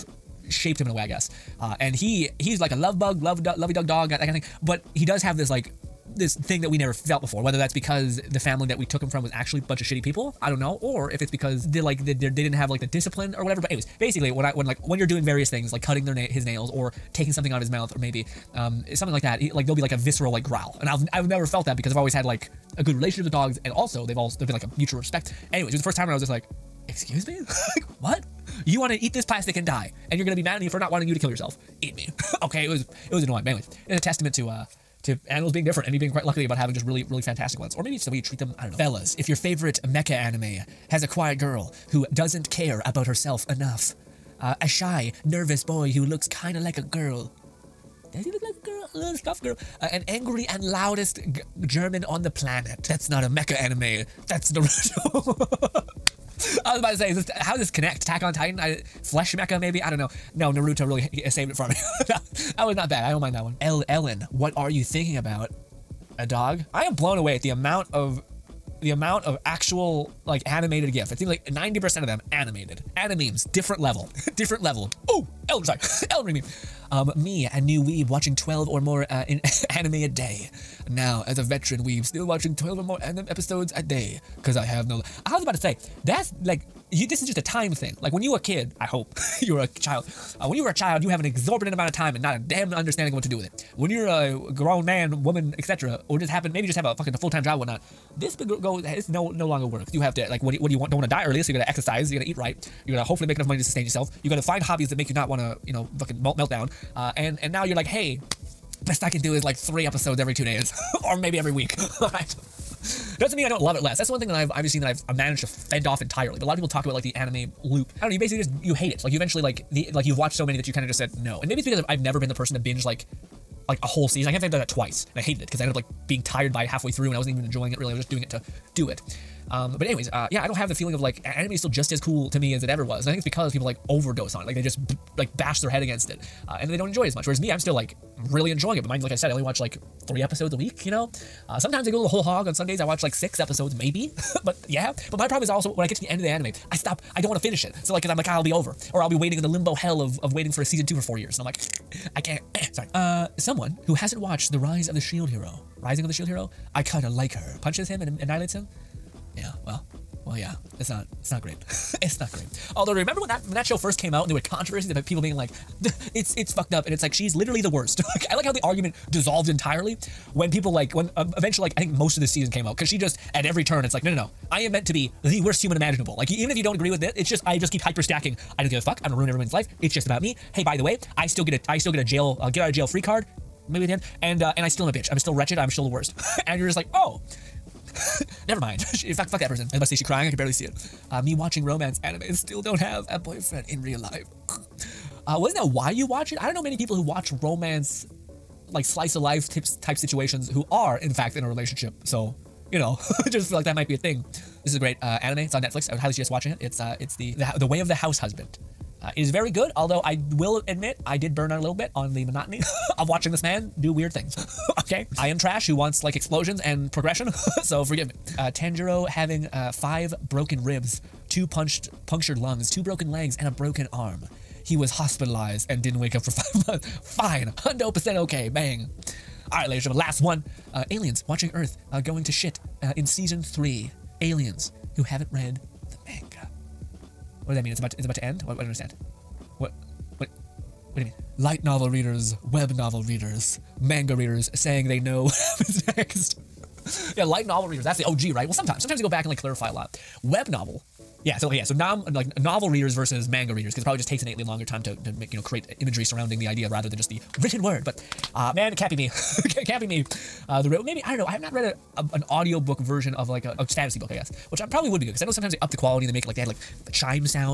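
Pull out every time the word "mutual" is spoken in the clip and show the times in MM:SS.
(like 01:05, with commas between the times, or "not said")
00:24.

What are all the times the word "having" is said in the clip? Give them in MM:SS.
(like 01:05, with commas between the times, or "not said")
00:36, 03:39.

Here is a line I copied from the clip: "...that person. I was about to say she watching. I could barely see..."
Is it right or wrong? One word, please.
wrong.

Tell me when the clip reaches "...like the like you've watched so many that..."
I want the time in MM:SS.
01:59.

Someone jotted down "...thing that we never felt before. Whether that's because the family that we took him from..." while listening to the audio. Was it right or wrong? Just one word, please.
right.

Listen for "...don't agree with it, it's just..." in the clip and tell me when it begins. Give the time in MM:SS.
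02:56.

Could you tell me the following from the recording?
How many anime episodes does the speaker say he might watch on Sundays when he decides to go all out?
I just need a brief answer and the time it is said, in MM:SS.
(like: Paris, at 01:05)
6, at 02:23.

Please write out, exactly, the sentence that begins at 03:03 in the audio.
Maybe at the end, and uh, and I still am a bitch.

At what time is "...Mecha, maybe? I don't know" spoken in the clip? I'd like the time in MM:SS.
00:59.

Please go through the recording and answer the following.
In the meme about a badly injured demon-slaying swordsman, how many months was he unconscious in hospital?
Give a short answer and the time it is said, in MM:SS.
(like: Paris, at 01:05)
5, at 03:46.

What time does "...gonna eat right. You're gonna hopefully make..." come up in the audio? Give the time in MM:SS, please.
01:42.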